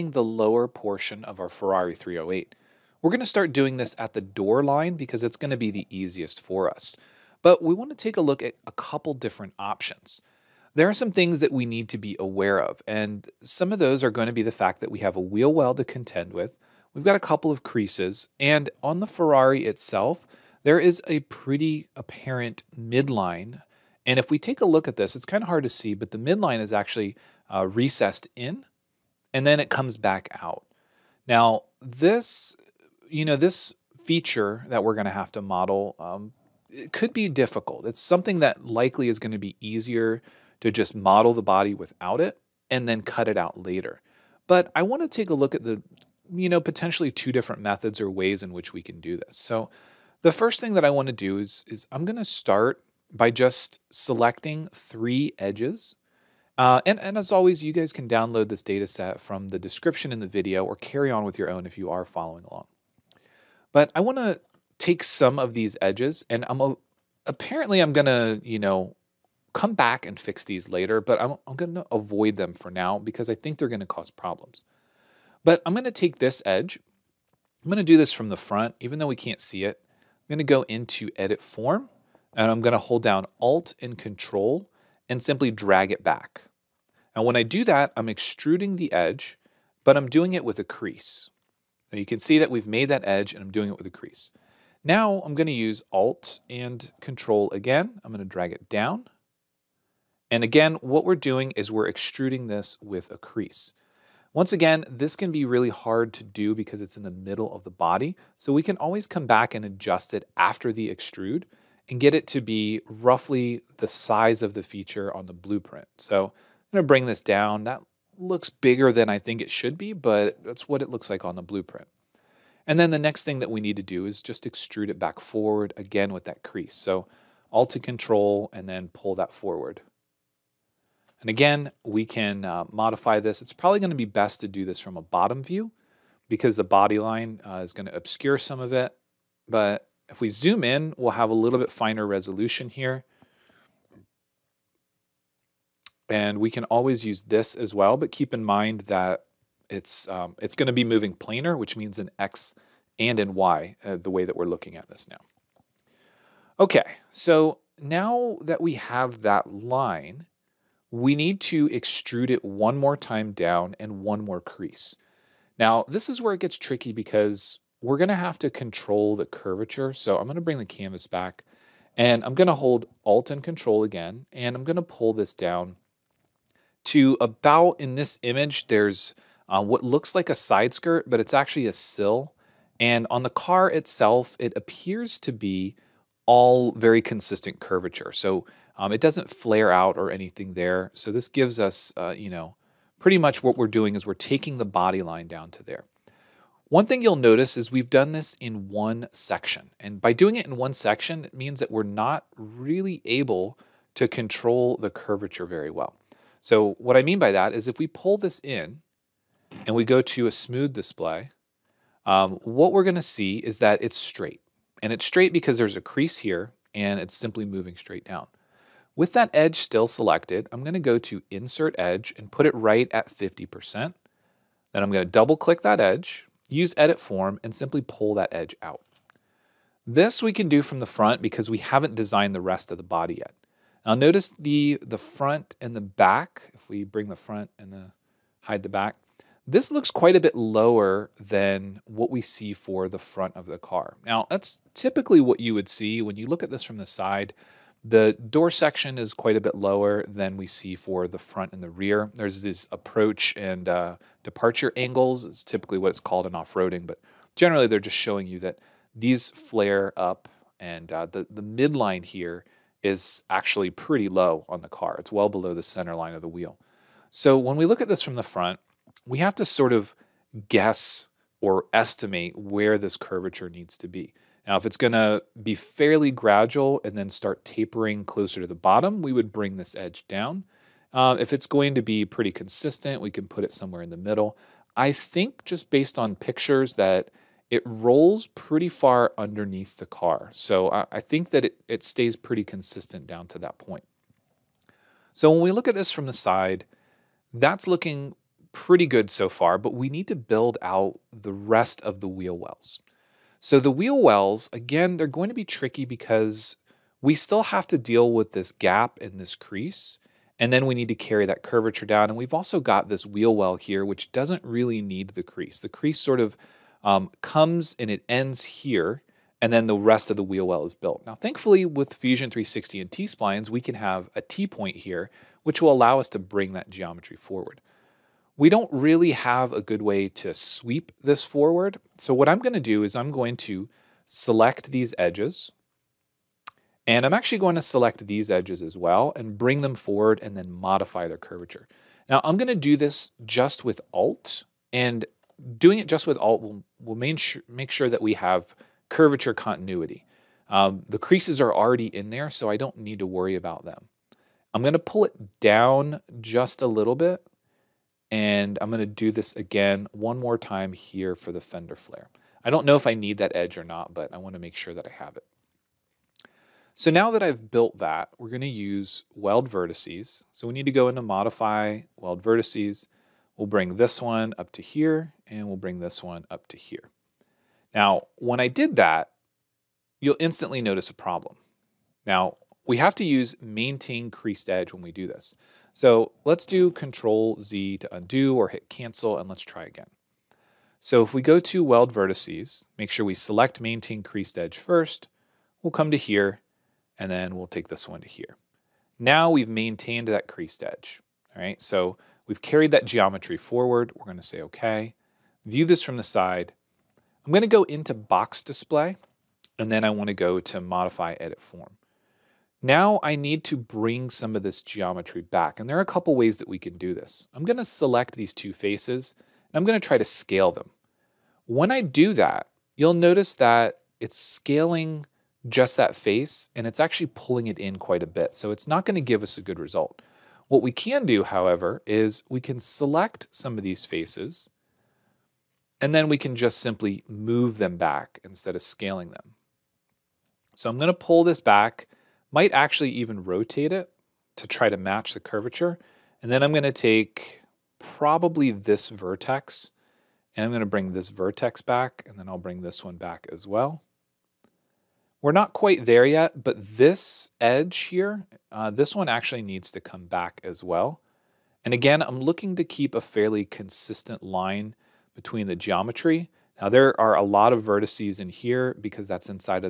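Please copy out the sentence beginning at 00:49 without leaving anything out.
So the first thing that I want to do is, is I'm going to start by just selecting three edges.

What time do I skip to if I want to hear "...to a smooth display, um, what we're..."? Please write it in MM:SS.
03:30.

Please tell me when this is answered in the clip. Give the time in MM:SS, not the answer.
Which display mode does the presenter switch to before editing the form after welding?
06:47.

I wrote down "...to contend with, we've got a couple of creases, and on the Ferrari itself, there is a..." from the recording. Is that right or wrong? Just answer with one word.
right.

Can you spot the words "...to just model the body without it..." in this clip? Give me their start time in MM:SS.
00:40.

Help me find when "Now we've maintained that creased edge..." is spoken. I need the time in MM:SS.
06:38.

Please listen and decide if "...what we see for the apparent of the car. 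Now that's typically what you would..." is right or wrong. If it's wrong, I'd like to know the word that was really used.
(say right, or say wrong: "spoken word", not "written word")
wrong: "front", not "apparent".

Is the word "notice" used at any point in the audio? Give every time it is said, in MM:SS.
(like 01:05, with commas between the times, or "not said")
03:17, 03:53, 06:20, 07:02.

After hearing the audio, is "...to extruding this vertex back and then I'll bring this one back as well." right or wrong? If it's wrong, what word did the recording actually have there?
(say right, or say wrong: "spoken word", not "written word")
wrong: "bring", not "extruding".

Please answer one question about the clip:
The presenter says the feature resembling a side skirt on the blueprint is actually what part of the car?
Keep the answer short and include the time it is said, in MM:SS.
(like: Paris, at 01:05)
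A sill, at 03:01.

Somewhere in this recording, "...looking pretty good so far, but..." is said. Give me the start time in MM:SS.
04:57.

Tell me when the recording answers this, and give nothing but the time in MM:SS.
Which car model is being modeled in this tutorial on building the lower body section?
00:01.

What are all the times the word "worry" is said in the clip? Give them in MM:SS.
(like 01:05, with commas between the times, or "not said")
05:53.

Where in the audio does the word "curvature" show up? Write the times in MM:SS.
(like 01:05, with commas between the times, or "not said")
02:49, 03:07, 03:24, 04:32, 05:11, 05:41, 05:48, 07:25.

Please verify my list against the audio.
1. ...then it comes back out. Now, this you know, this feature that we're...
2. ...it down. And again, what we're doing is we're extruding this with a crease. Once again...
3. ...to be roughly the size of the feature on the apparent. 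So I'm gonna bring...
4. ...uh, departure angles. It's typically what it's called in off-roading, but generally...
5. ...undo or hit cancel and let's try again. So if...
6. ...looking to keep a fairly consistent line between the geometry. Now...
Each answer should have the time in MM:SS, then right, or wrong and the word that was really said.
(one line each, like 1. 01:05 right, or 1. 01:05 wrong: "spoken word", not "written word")
1. 00:29 right
2. 01:38 right
3. 01:52 wrong: "blueprint", not "apparent"
4. 04:13 right
5. 06:27 right
6. 07:42 right.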